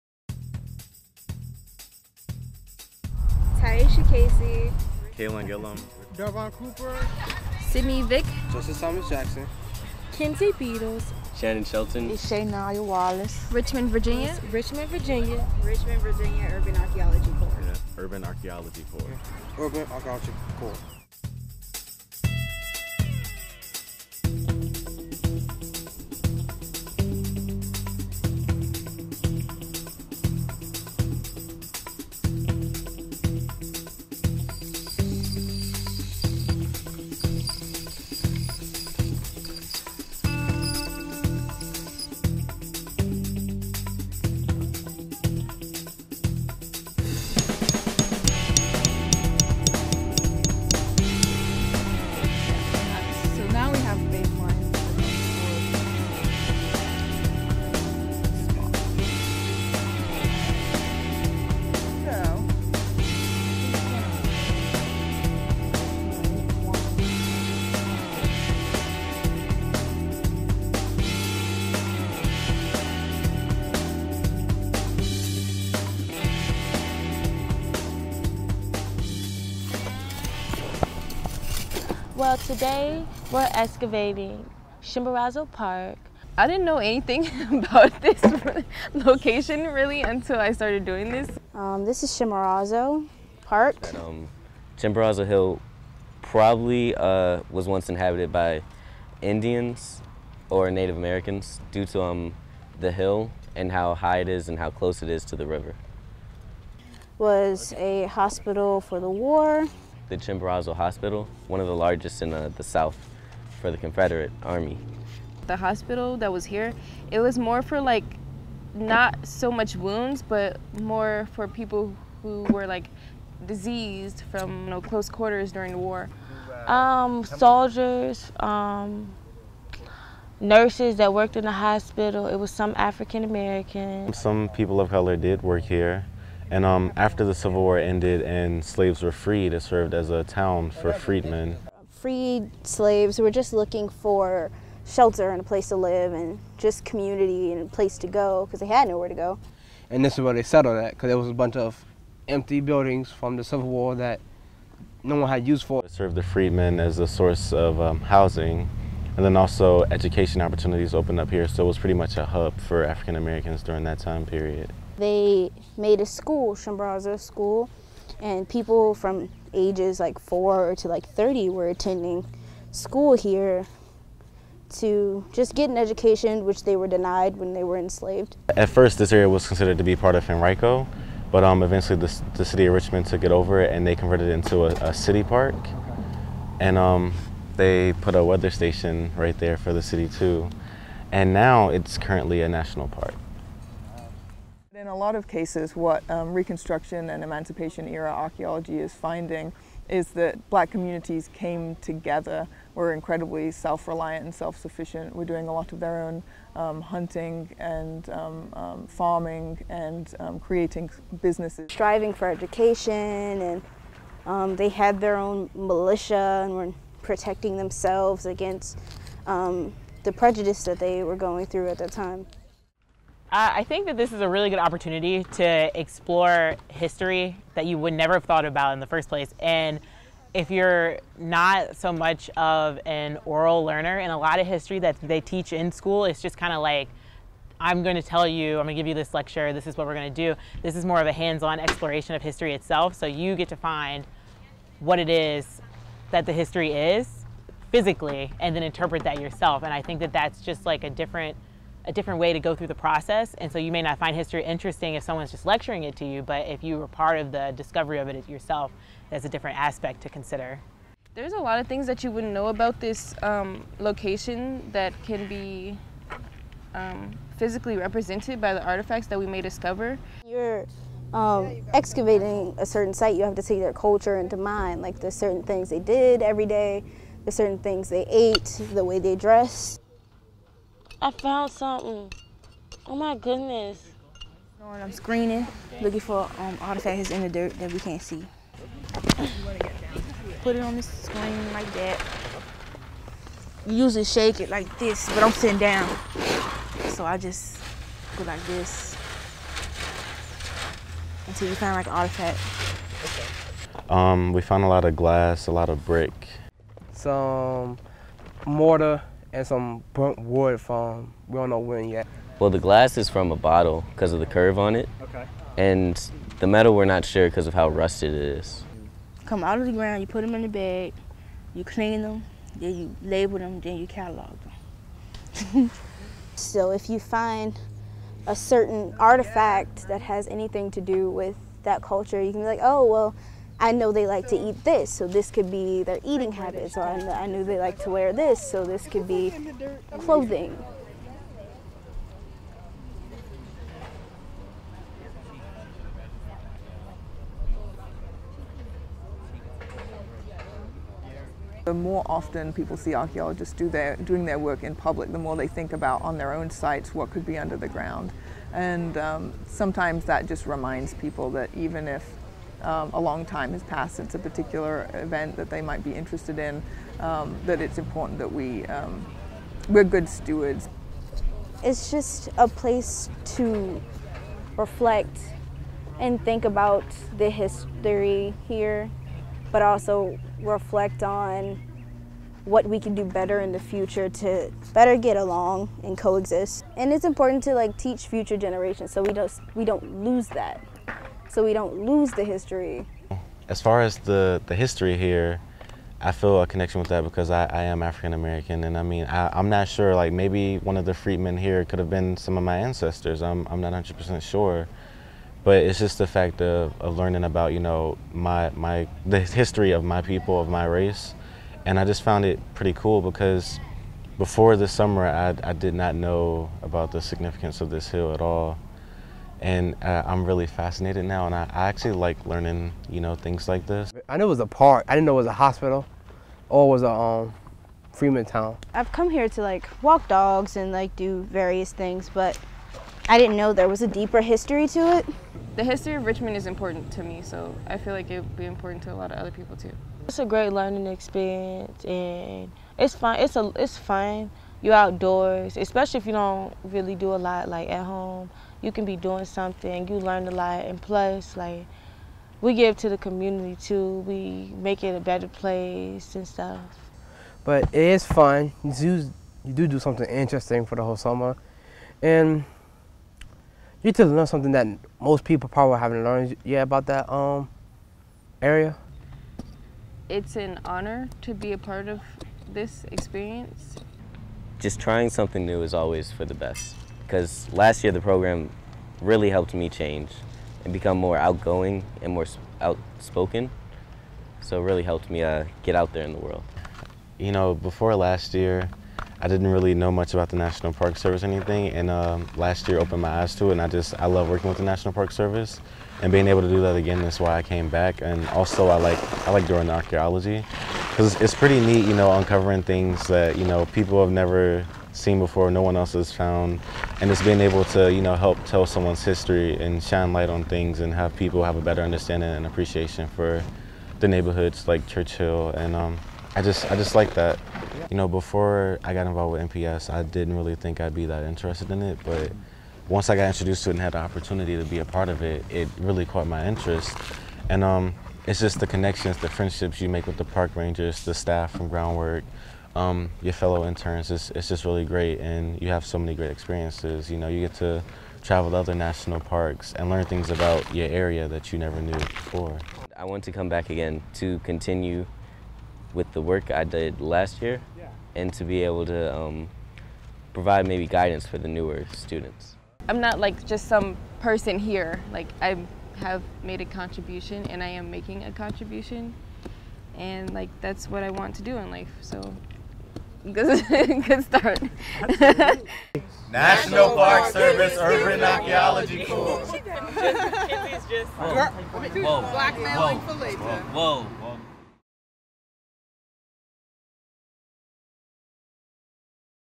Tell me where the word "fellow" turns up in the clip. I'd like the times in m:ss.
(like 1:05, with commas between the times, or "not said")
8:53.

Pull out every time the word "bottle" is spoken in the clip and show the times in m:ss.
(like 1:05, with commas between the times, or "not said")
5:13.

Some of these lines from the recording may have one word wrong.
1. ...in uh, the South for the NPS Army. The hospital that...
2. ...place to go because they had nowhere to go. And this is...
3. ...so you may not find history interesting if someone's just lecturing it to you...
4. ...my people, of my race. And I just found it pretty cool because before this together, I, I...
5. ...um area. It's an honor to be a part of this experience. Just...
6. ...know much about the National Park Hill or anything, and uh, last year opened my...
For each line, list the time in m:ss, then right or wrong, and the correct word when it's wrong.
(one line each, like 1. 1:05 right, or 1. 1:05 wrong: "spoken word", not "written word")
1. 1:52 wrong: "Confederate", not "NPS"
2. 2:27 right
3. 4:13 right
4. 6:49 wrong: "summer", not "together"
5. 7:47 right
6. 8:09 wrong: "Service", not "Hill".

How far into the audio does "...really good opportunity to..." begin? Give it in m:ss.
3:44.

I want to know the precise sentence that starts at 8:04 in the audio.
So it really helped me uh, get out there in the world.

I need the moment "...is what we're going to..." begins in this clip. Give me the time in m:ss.
3:59.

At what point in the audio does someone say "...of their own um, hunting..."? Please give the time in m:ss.
3:25.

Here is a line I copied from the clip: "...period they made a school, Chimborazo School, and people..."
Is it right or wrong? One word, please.
right.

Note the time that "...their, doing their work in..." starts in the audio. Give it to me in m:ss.
5:53.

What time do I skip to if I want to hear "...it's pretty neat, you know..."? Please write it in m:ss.
8:21.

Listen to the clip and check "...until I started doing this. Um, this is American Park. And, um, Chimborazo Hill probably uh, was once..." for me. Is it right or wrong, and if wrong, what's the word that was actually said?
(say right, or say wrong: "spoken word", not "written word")
wrong: "Chimborazo", not "American".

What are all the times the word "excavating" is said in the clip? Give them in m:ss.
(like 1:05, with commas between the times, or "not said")
1:23, 4:31.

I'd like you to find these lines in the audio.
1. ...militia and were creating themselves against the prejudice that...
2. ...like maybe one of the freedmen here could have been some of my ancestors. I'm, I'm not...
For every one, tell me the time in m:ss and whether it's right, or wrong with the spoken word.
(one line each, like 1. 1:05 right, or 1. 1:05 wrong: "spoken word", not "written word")
1. 3:35 wrong: "protecting", not "creating"
2. 6:39 right.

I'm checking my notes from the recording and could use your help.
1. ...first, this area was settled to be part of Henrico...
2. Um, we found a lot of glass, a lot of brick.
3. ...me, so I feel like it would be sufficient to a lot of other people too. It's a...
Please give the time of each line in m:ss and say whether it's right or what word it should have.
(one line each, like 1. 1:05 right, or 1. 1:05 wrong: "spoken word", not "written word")
1. 2:58 wrong: "considered", not "settled"
2. 5:03 right
3. 7:17 wrong: "important", not "sufficient".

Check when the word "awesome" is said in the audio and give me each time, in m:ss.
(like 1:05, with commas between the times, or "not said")
not said.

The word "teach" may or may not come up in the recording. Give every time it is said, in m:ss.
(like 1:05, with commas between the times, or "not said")
3:55, 6:27.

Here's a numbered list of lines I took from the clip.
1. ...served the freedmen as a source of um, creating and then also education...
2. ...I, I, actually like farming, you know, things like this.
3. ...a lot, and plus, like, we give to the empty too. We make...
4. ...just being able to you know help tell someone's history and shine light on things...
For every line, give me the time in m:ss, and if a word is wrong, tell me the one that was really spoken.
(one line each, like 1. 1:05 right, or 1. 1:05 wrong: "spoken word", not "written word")
1. 2:35 wrong: "housing", not "creating"
2. 7:01 wrong: "learning", not "farming"
3. 7:30 wrong: "community", not "empty"
4. 8:27 right.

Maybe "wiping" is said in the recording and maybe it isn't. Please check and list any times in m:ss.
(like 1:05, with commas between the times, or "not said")
not said.